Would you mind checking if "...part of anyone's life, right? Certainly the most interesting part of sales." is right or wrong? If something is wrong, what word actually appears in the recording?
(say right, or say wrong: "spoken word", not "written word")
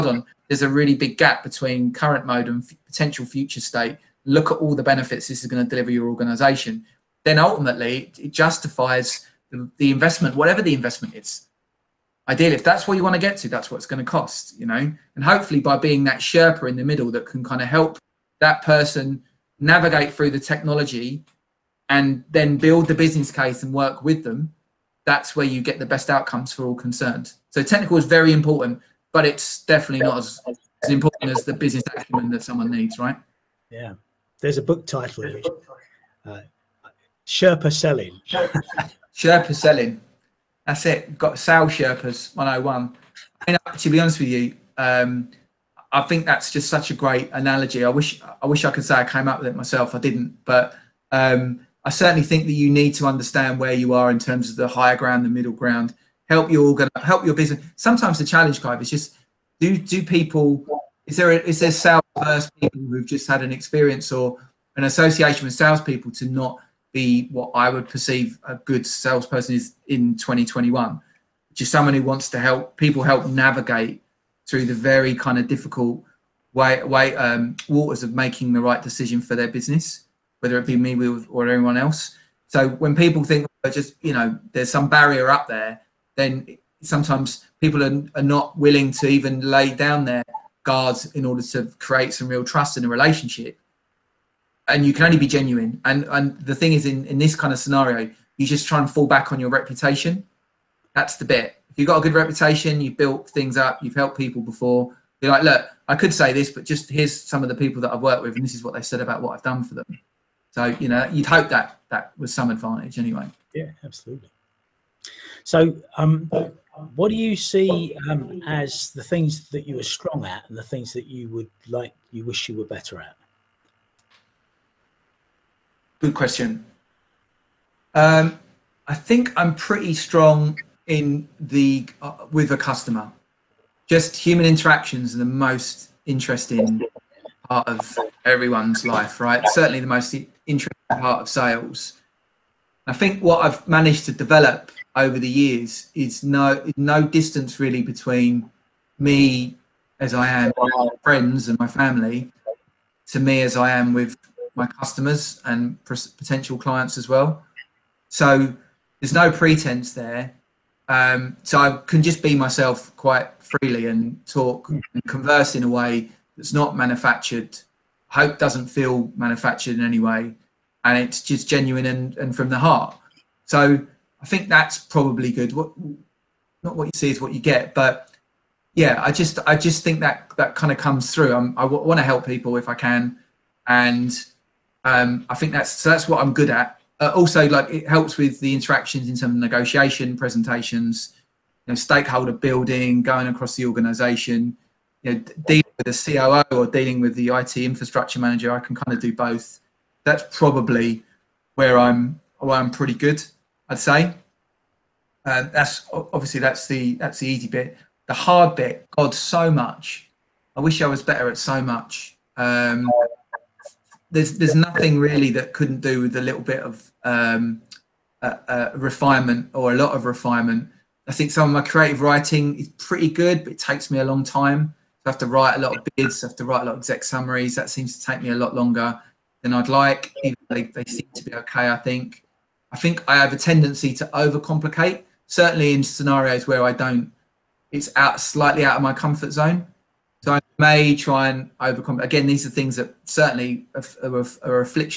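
wrong: "everyone", not "anyone".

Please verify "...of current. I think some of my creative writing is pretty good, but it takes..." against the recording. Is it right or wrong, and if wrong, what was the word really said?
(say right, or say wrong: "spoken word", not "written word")
wrong: "refinement", not "current".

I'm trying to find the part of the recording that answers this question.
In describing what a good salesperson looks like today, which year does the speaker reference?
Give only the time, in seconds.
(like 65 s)
70 s.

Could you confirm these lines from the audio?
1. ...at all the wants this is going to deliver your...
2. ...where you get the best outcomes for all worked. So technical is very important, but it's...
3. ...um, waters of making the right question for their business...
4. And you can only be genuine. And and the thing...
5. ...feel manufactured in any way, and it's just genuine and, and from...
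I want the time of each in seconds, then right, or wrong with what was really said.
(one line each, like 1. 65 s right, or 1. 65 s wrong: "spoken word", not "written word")
1. 4 s wrong: "benefits", not "wants"
2. 25 s wrong: "concerned", not "worked"
3. 77 s wrong: "decision", not "question"
4. 94 s right
5. 168 s right.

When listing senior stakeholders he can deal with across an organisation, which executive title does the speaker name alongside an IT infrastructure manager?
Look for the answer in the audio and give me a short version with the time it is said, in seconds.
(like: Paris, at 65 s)
COO, at 196 s.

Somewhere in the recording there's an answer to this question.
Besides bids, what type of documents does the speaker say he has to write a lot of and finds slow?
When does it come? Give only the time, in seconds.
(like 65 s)
226 s.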